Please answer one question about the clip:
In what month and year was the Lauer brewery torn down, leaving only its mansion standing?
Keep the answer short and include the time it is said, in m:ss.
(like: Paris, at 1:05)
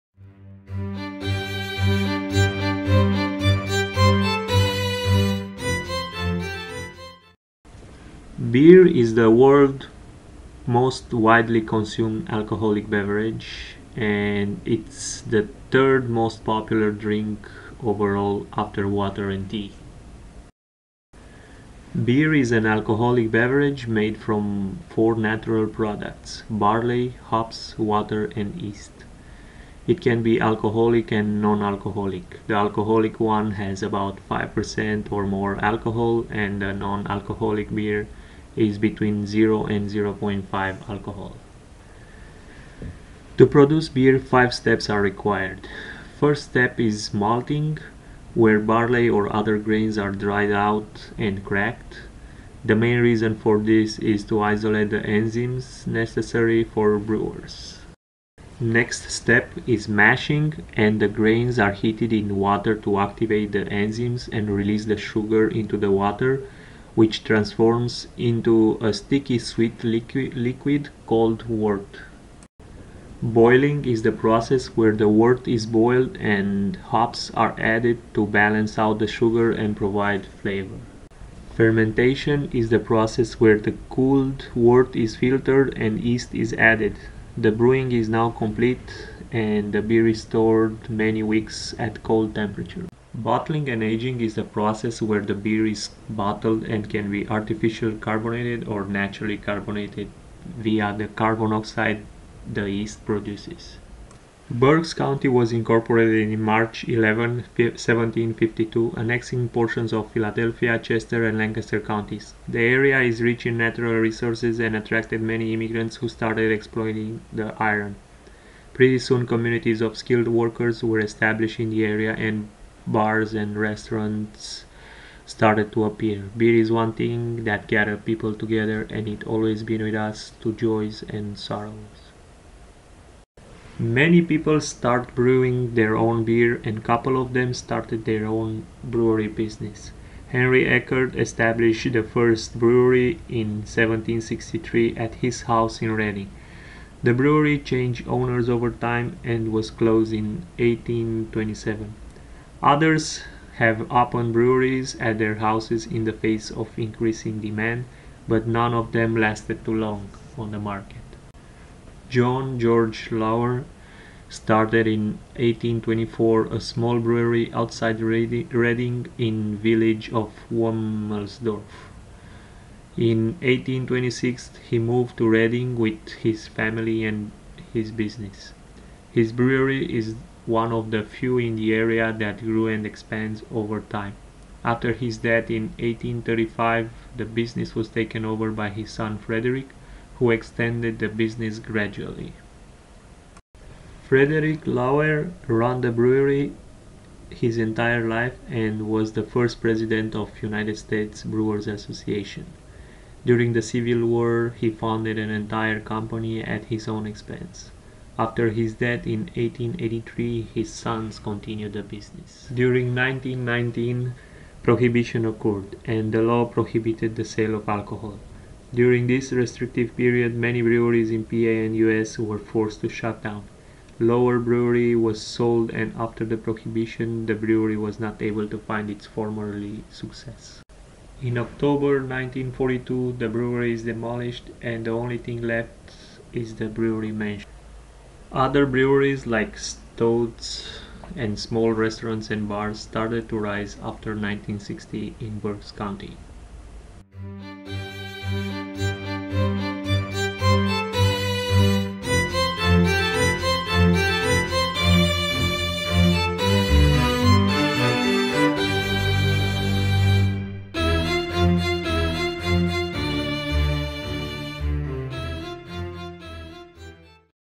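October 1942, at 3:51.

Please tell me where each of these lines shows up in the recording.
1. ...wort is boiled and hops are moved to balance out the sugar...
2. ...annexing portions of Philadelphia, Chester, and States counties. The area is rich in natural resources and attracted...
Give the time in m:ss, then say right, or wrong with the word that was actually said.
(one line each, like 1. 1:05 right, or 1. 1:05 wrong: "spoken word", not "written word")
1. 1:15 wrong: "added", not "moved"
2. 1:48 wrong: "Lancaster", not "States".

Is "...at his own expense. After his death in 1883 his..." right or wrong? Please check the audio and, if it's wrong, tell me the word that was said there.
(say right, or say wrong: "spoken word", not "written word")
right.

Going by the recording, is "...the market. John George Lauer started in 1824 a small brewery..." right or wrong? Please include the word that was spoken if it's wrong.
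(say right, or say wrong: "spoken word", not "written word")
right.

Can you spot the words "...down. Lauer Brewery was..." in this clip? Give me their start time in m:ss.
3:43.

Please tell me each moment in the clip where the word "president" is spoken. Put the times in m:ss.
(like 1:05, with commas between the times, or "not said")
3:19.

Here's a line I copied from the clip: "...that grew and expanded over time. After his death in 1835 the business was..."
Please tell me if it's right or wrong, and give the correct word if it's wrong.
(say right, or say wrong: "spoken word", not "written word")
right.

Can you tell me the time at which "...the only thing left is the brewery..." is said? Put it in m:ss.
3:54.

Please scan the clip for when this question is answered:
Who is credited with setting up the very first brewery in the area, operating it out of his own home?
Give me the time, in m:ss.
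2:20.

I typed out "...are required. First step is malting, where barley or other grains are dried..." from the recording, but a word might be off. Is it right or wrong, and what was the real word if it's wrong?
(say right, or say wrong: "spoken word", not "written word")
right.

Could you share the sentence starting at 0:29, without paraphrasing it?
It can be alcoholic and non alcoholic.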